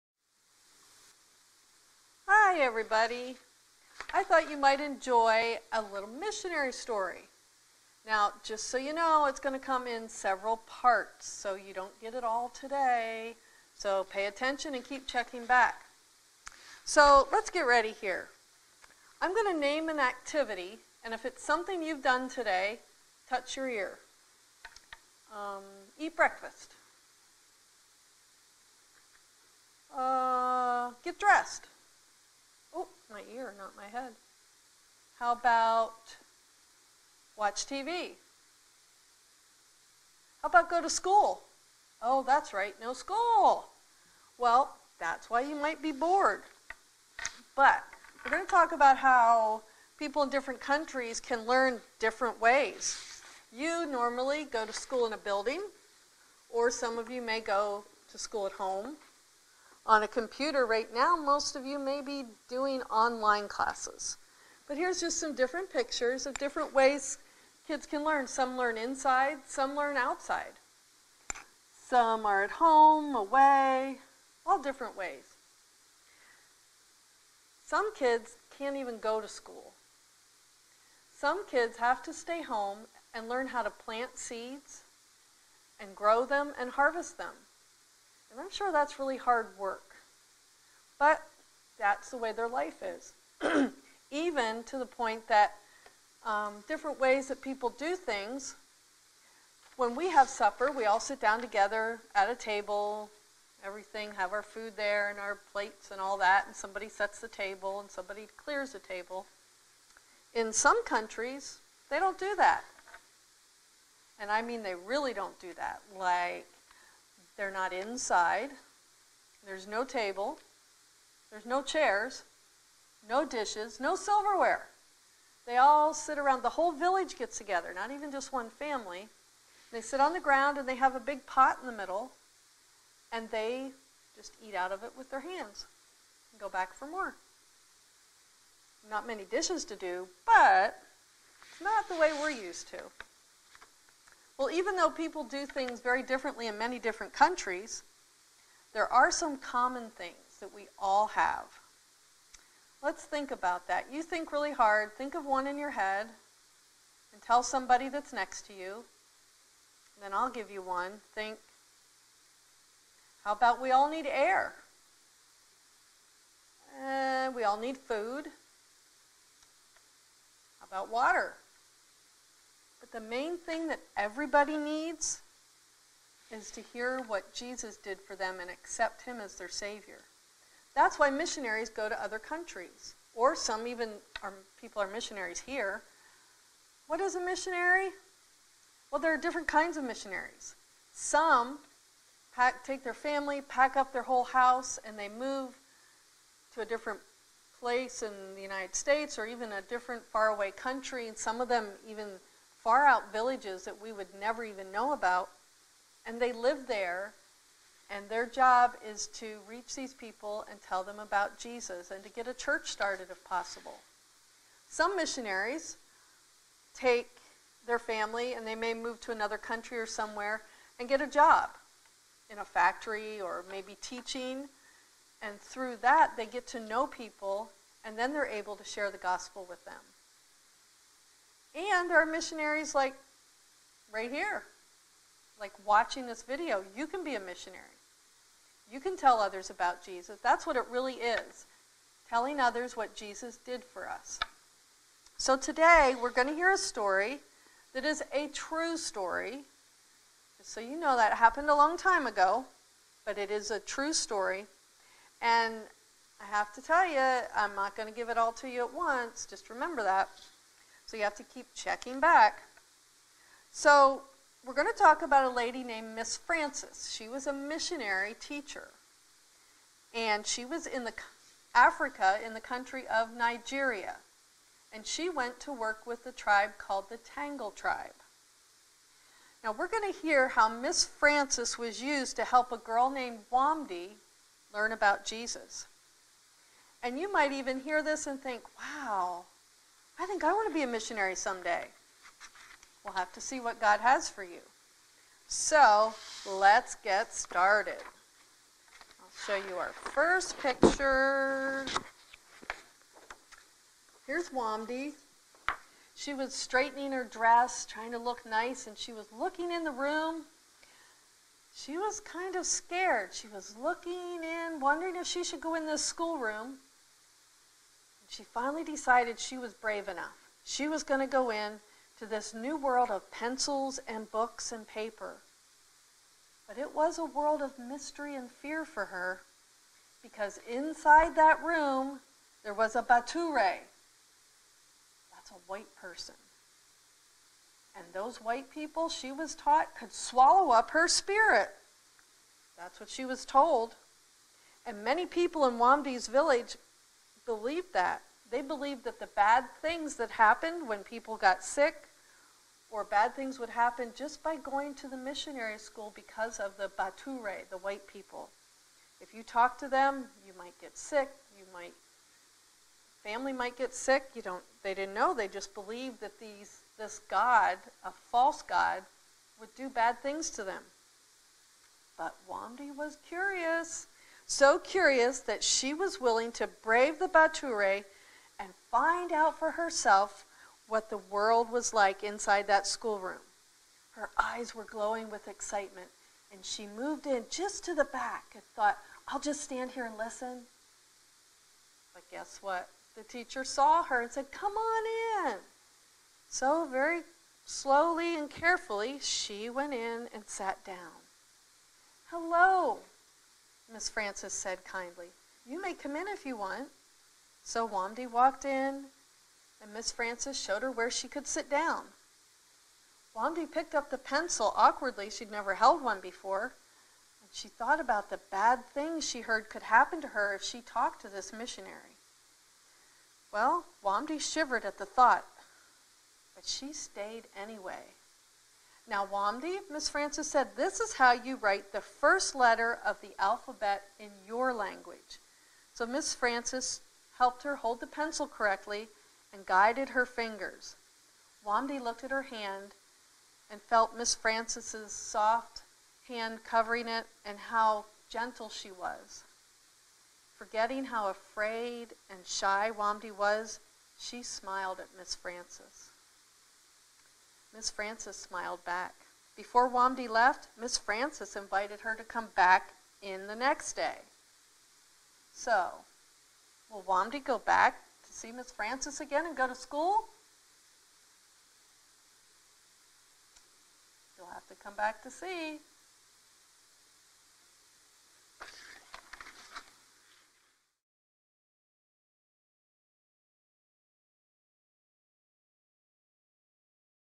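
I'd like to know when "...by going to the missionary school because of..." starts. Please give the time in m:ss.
5:54.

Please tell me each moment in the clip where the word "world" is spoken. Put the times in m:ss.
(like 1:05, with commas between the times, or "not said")
5:22, 5:27, 6:20.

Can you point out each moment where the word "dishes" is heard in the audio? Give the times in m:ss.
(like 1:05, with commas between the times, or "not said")
2:03, 2:19.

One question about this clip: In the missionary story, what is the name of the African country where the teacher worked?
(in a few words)
Nigeria.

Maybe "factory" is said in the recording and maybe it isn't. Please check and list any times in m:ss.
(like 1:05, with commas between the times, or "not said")
3:42.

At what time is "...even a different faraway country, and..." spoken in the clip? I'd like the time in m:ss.
3:19.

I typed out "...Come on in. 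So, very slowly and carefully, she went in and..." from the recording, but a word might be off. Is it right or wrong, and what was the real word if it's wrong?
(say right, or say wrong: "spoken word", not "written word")
right.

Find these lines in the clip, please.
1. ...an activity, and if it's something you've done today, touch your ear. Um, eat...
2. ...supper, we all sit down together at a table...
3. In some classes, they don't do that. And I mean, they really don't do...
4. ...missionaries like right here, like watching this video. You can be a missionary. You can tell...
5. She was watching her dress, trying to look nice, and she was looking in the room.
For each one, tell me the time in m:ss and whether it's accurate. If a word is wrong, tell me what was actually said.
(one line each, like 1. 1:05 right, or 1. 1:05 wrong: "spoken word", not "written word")
1. 0:19 right
2. 1:40 right
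3. 1:50 wrong: "countries", not "classes"
4. 3:52 right
5. 5:05 wrong: "straightening", not "watching".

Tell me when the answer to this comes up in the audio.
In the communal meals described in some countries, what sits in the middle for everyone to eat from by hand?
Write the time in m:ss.
2:10.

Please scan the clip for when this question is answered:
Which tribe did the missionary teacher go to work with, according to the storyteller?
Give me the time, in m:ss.
4:36.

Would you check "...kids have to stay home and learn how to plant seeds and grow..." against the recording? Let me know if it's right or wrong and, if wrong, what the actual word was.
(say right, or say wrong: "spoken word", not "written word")
right.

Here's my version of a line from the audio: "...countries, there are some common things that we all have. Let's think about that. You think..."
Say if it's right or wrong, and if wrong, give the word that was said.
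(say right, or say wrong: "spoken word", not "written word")
right.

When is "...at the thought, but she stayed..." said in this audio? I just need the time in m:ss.
7:04.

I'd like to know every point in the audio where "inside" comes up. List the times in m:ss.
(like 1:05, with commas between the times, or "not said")
1:08, 1:57, 5:30, 6:22.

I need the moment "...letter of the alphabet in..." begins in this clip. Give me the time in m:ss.
7:12.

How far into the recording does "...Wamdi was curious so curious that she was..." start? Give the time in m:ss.
6:12.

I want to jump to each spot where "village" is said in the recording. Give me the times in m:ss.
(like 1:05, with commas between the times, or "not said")
2:06, 3:23, 5:46.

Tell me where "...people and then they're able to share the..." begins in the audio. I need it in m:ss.
3:46.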